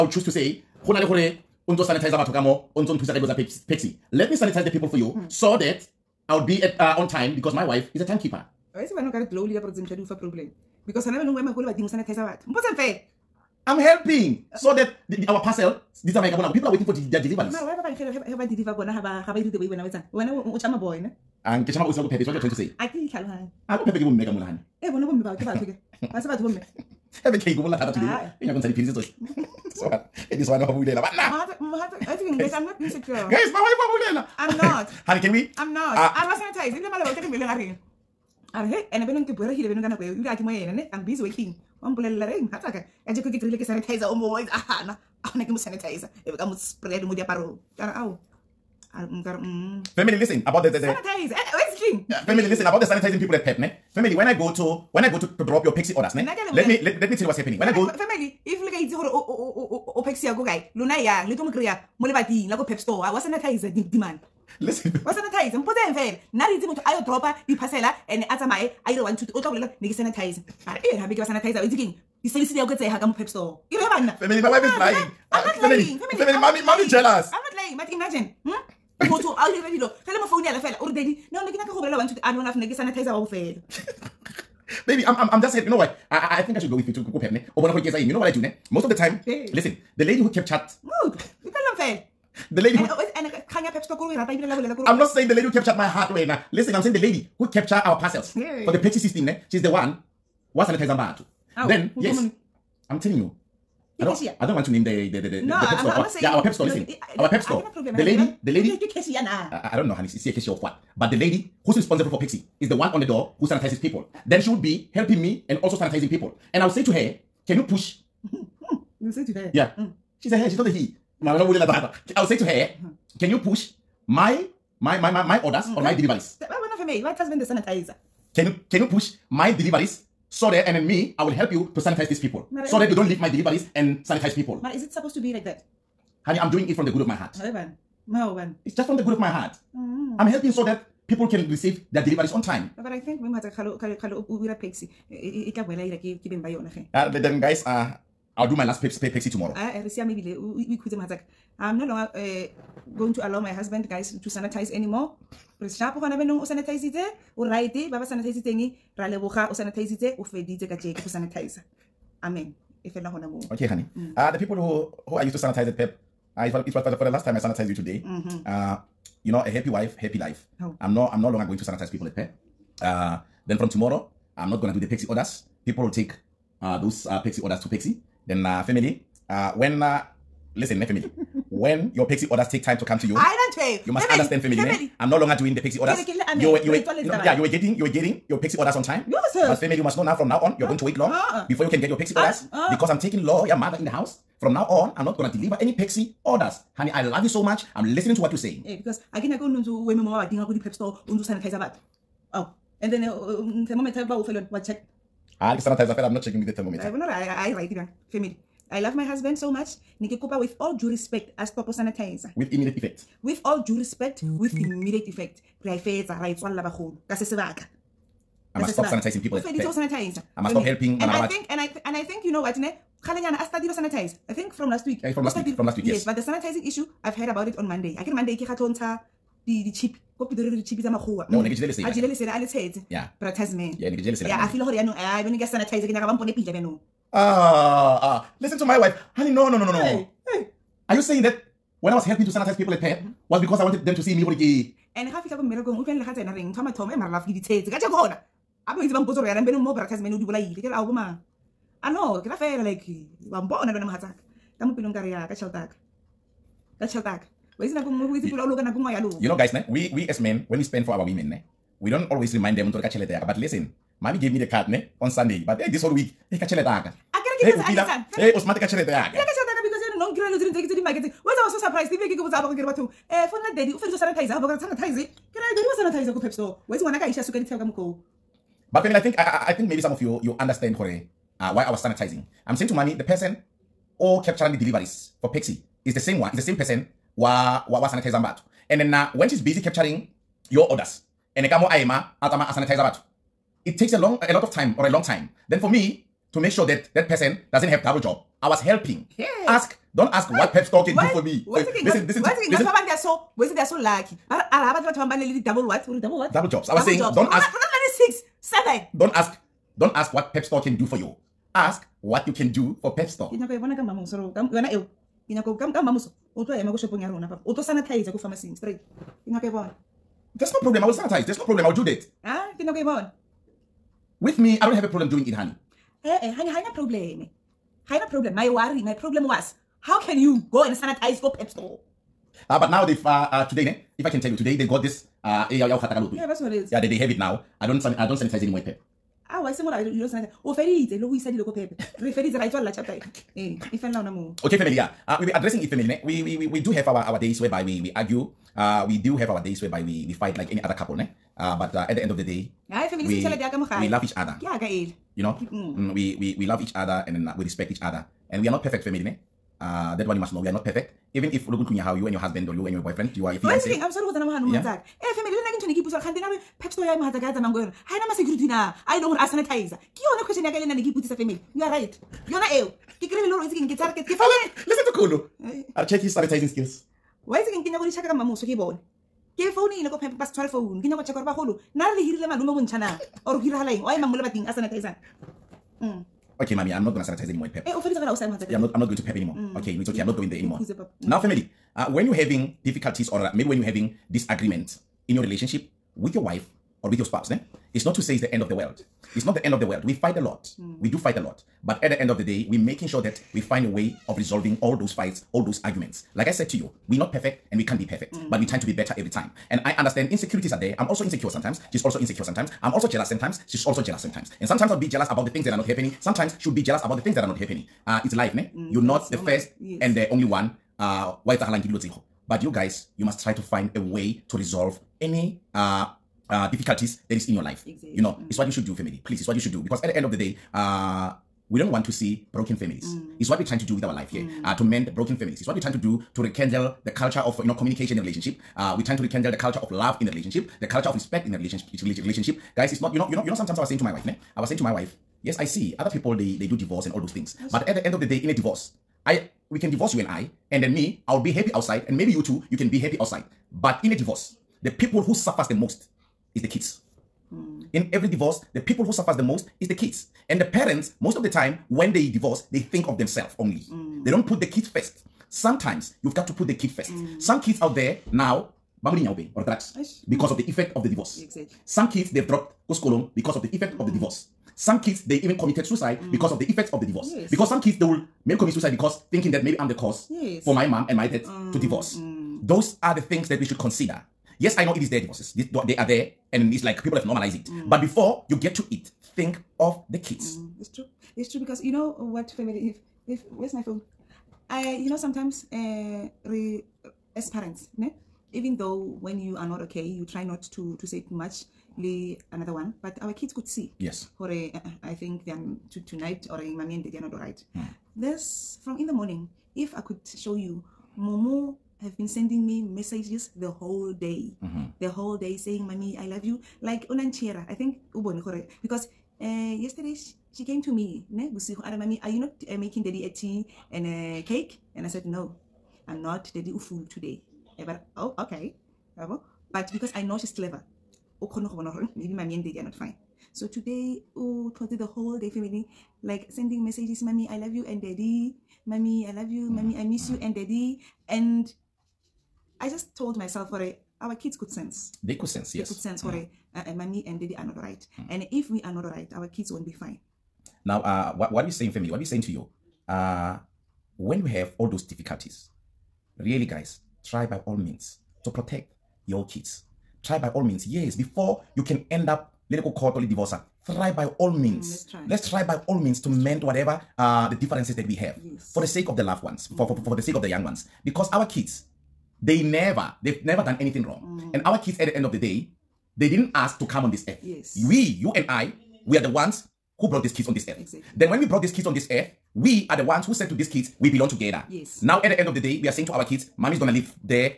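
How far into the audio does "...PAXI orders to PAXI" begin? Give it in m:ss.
2:57.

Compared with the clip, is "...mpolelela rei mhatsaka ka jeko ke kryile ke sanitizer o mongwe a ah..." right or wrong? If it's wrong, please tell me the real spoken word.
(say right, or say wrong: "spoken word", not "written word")
right.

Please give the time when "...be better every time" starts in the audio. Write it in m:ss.
6:48.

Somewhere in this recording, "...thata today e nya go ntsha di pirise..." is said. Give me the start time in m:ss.
0:27.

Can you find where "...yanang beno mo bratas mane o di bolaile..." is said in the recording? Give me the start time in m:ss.
4:09.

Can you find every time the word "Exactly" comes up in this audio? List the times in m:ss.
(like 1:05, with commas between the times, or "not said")
7:07, 7:51, 9:40.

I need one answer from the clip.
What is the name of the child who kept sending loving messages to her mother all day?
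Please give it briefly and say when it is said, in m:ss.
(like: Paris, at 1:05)
Momo, at 8:30.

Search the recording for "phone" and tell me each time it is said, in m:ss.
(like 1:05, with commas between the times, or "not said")
4:33, 8:13.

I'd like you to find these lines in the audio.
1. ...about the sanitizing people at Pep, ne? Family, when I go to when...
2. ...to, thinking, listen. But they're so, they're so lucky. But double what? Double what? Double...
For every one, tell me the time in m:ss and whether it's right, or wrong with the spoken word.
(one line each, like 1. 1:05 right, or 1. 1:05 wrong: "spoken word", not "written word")
1. 0:52 right
2. 5:02 right.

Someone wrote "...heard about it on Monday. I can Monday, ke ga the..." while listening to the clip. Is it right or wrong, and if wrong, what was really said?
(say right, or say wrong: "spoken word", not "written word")
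right.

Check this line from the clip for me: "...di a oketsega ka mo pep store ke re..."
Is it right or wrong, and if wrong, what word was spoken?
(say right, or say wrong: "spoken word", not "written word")
right.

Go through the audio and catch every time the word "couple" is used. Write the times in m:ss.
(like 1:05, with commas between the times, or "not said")
5:50.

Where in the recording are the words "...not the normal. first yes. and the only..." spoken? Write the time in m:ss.
6:58.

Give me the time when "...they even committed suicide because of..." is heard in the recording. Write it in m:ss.
7:55.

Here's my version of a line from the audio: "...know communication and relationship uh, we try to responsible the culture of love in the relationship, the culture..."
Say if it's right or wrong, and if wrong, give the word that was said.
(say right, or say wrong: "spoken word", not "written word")
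wrong: "rekindle", not "responsible".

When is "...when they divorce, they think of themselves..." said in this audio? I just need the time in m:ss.
7:41.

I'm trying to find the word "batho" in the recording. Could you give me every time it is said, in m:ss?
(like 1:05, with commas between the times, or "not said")
0:02, 0:12, 4:32, 4:52.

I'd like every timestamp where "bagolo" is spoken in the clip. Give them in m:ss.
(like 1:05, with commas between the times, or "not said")
3:36, 6:21.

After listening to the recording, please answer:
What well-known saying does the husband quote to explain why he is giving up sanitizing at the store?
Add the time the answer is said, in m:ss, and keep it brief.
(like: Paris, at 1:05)
Happy wife, happy life, at 2:49.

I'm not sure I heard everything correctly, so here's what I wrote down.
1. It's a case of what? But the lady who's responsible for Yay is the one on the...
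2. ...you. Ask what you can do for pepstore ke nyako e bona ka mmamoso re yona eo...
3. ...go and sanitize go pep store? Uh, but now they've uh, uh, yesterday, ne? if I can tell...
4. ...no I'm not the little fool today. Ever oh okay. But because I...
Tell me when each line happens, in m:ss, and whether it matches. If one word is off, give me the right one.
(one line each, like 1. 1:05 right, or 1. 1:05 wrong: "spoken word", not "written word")
1. 1:50 wrong: "Pepsi", not "Yay"
2. 5:10 right
3. 5:30 wrong: "today", not "yesterday"
4. 8:45 right.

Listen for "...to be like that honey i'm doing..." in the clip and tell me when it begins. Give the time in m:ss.
2:15.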